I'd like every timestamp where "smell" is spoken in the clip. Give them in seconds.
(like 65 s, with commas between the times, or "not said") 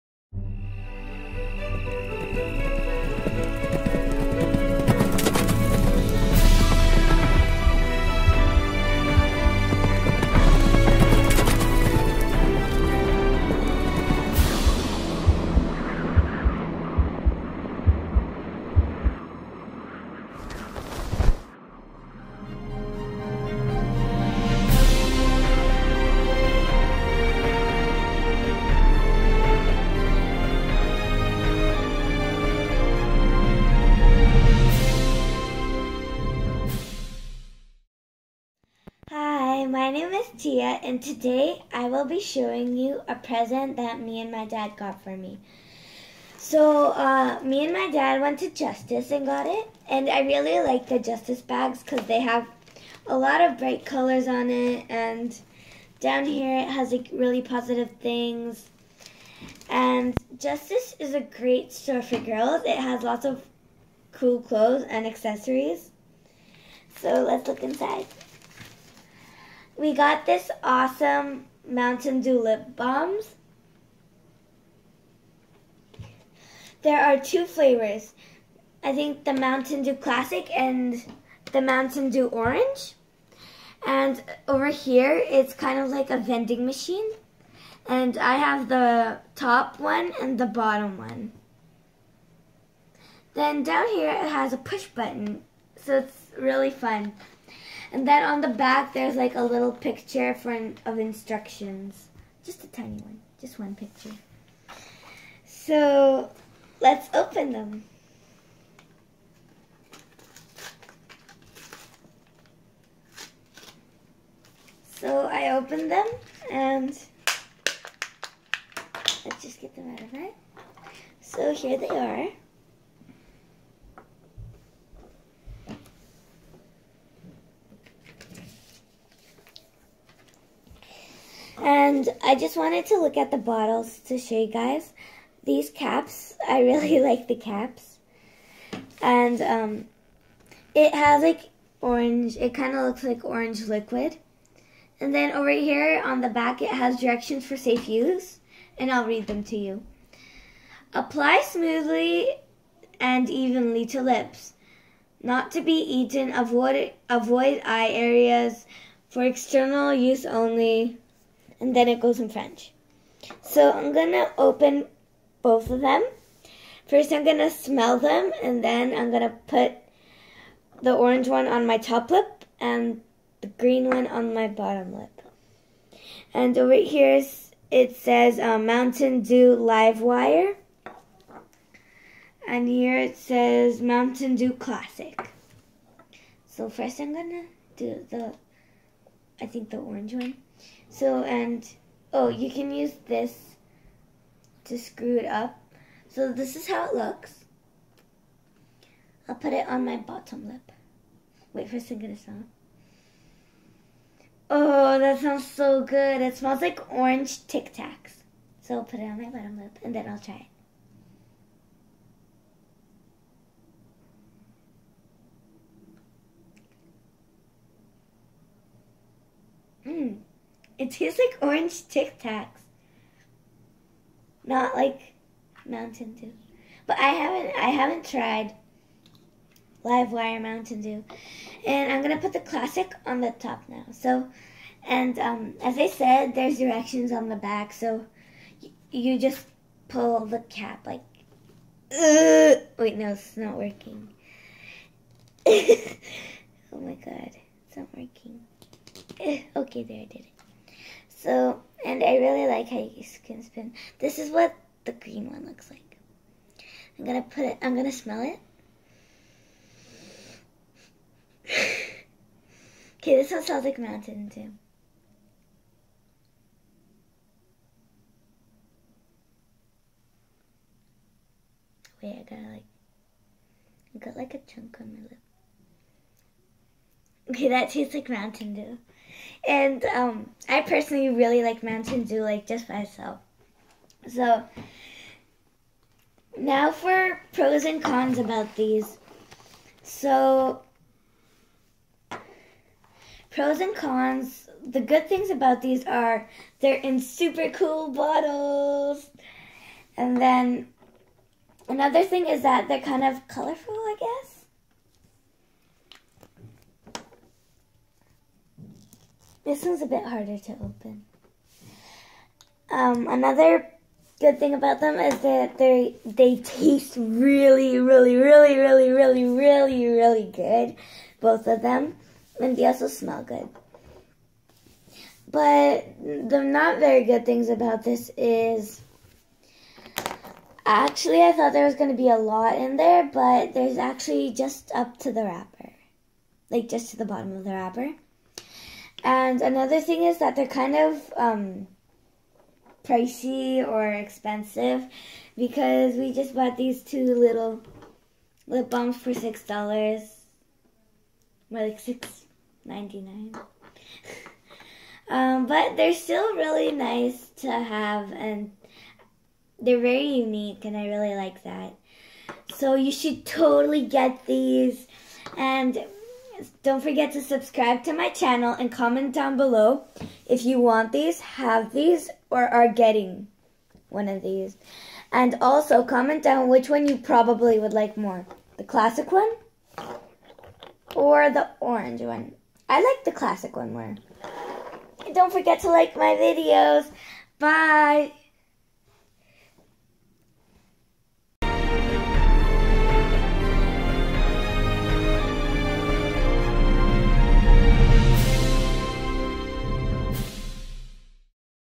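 167 s, 206 s, 257 s, 263 s, 322 s.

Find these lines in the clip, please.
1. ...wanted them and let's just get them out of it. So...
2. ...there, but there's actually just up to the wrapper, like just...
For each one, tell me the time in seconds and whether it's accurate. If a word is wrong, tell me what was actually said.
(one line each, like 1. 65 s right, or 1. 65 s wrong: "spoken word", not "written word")
1. 115 s wrong: "opened", not "wanted"
2. 332 s right.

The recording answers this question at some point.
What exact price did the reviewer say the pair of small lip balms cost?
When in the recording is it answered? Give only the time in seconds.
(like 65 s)
351 s.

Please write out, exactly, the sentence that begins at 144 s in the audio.
And then over here on the back, it has directions for safe use.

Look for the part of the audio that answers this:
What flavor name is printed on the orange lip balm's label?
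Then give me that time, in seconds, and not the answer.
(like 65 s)
178 s.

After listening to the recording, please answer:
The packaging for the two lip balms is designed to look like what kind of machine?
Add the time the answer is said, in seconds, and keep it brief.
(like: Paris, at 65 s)
Vending machine, at 86 s.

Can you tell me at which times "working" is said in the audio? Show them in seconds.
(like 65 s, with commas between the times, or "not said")
243 s, 247 s.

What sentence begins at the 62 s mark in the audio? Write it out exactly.
It has lots of cool clothes and accessories.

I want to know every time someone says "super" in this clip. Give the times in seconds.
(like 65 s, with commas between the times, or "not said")
296 s.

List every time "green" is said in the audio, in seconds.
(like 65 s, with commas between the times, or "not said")
173 s, 254 s.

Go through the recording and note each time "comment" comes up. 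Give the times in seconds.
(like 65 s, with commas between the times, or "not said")
368 s, 375 s.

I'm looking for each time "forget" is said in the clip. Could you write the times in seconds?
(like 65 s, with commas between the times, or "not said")
366 s, 385 s.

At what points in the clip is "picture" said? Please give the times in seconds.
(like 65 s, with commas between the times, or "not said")
99 s, 103 s.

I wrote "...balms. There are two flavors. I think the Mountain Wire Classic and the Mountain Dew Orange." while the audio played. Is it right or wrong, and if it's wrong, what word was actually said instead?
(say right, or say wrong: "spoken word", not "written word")
wrong: "Dew", not "Wire".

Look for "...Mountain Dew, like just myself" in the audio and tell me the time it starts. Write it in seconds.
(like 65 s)
281 s.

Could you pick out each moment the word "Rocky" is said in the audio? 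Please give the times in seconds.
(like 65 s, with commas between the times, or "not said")
not said.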